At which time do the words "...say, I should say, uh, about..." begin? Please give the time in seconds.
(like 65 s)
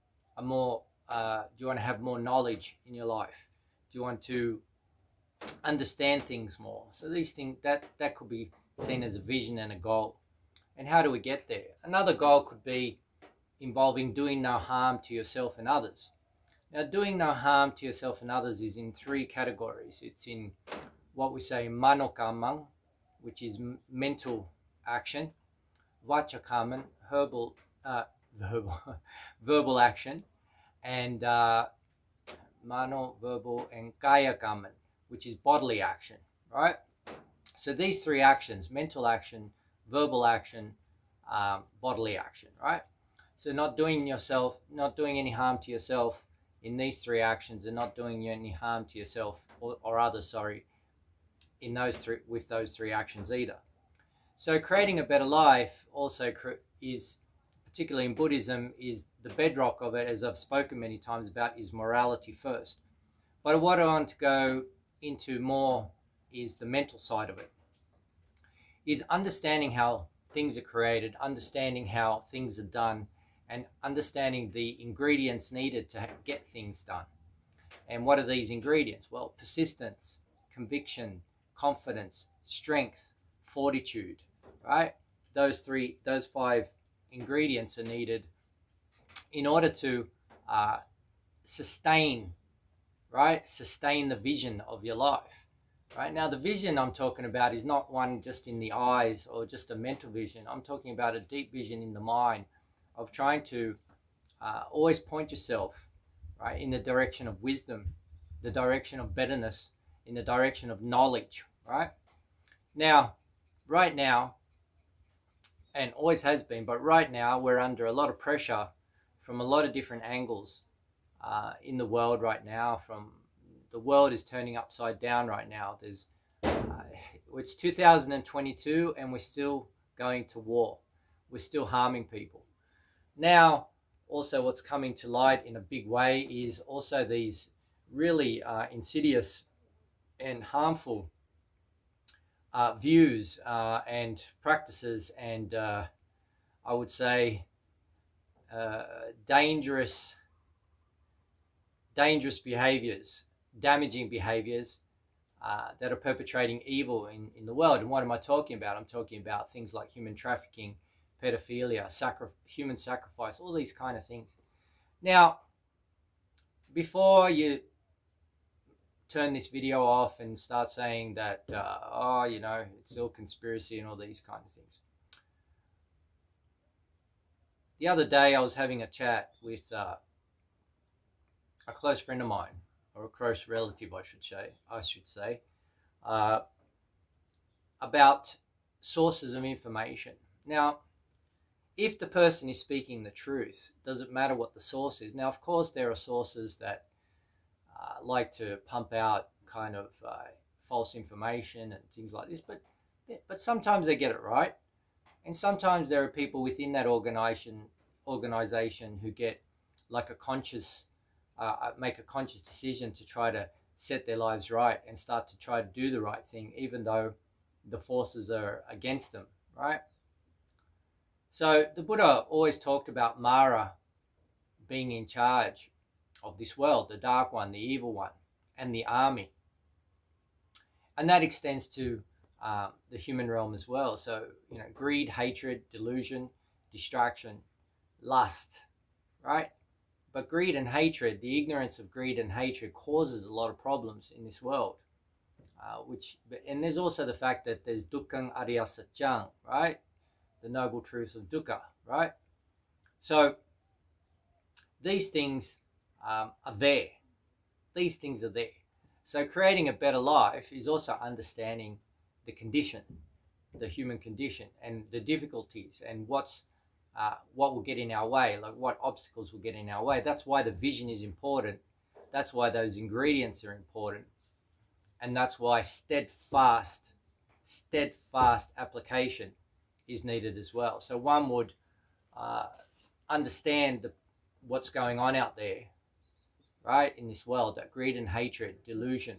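184 s.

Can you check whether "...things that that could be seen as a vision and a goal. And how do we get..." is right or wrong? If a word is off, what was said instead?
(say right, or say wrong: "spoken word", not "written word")
right.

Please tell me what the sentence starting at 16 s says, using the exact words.
Now, doing no harm to yourself and others is in three categories.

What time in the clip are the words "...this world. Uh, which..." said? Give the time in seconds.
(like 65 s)
244 s.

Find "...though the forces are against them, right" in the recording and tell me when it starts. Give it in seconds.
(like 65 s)
216 s.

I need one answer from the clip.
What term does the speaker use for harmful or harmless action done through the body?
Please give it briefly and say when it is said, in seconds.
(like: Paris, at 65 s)
kayakaman, at 34 s.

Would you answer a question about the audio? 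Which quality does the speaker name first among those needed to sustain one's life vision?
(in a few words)
persistence.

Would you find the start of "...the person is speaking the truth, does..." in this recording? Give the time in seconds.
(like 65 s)
191 s.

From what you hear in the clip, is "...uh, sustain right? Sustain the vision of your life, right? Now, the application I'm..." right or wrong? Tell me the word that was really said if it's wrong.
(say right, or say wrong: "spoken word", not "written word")
wrong: "vision", not "application".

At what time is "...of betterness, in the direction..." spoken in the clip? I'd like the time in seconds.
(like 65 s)
108 s.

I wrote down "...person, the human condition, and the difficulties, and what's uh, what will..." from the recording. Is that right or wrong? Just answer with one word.
wrong.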